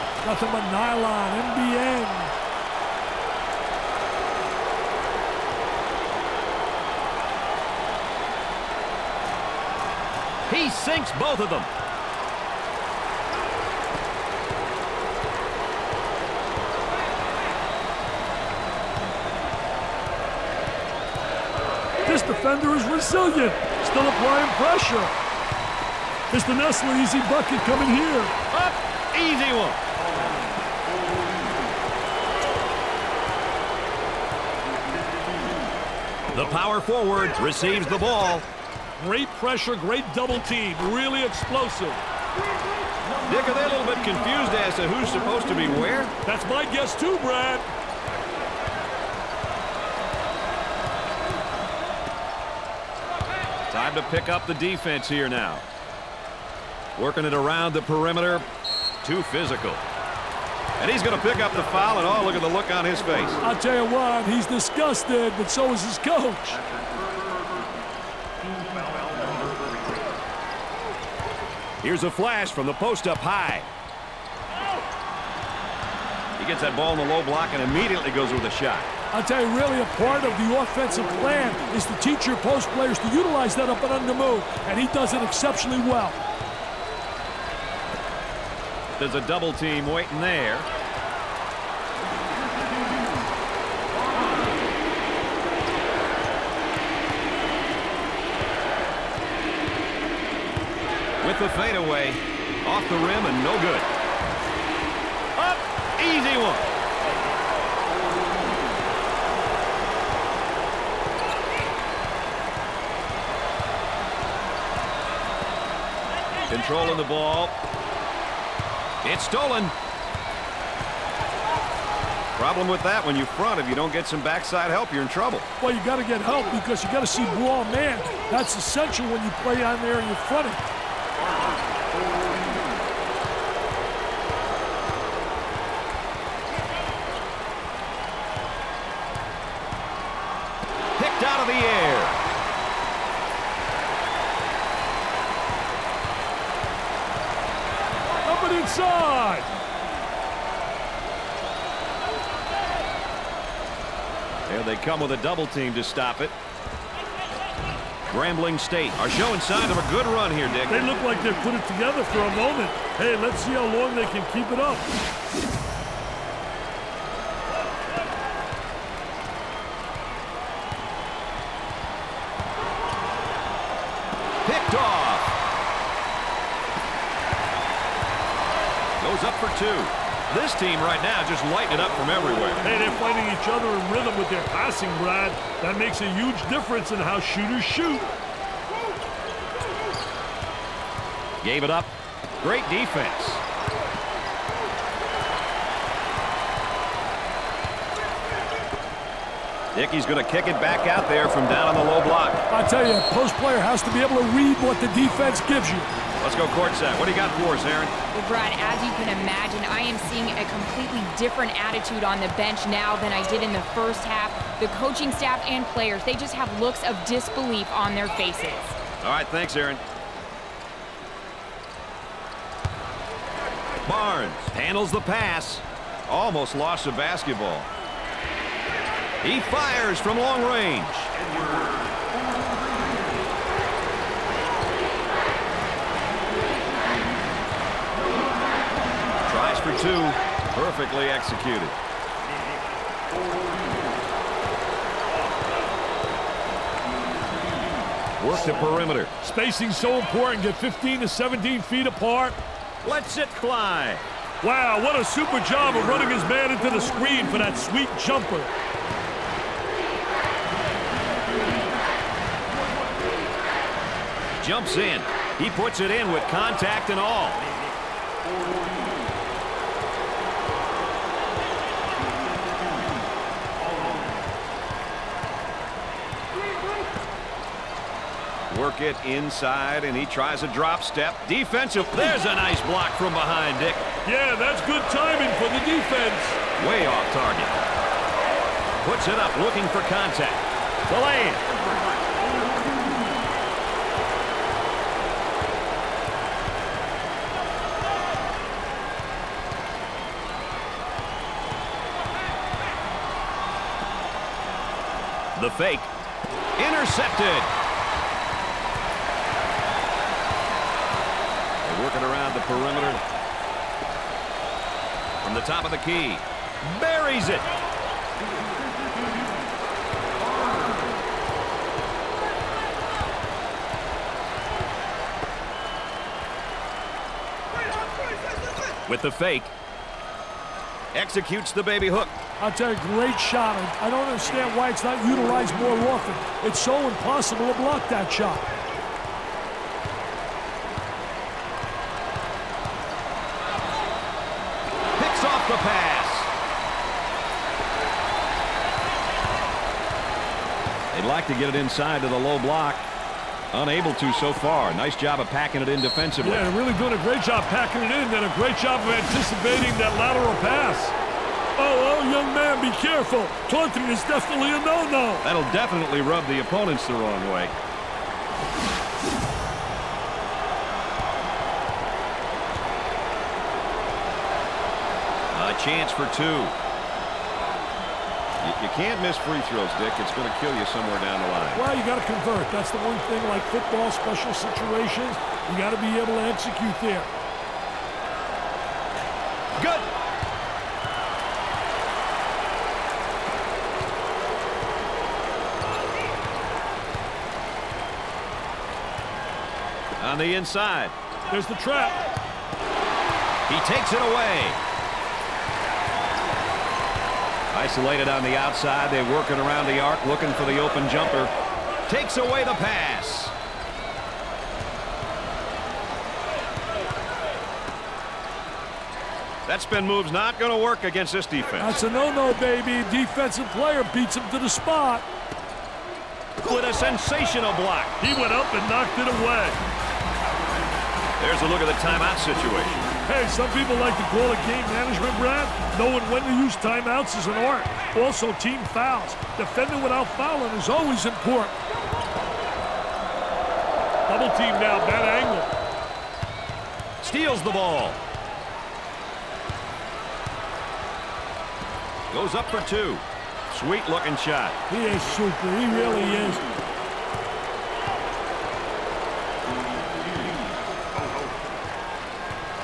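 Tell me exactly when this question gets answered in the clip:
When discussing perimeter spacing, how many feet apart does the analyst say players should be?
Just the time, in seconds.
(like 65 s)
250 s.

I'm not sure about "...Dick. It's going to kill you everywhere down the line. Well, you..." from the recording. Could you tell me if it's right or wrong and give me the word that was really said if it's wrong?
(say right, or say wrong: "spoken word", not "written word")
wrong: "somewhere", not "everywhere".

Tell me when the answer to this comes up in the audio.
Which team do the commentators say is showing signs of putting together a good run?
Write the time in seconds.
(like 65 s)
158 s.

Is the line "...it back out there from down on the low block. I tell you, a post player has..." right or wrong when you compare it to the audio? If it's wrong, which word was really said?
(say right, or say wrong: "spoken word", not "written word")
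right.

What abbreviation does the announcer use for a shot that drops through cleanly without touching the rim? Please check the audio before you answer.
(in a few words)
NBN.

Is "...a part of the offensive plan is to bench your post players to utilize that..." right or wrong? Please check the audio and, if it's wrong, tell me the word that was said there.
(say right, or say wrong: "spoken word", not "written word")
wrong: "teach", not "bench".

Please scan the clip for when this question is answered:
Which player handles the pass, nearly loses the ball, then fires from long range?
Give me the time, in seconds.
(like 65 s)
223 s.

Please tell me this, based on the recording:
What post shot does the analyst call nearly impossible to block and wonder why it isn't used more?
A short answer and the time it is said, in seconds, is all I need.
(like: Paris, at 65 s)
baby hook, at 331 s.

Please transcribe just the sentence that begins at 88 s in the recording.
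There's a double team waiting there.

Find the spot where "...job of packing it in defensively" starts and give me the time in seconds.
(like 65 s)
354 s.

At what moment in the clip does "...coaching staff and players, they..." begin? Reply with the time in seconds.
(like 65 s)
214 s.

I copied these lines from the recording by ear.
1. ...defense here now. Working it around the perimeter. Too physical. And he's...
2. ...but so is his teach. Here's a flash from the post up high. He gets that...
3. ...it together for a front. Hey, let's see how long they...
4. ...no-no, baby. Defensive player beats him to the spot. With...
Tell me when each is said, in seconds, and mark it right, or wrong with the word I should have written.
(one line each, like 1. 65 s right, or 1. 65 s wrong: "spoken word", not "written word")
1. 54 s right
2. 65 s wrong: "coach", not "teach"
3. 161 s wrong: "moment", not "front"
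4. 421 s right.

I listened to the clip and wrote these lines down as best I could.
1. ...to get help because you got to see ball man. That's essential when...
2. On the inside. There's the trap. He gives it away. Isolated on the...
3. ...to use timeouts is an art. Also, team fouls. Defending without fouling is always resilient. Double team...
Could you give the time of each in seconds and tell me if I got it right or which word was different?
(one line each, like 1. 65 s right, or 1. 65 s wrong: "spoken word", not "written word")
1. 125 s right
2. 400 s wrong: "takes", not "gives"
3. 436 s wrong: "important", not "resilient".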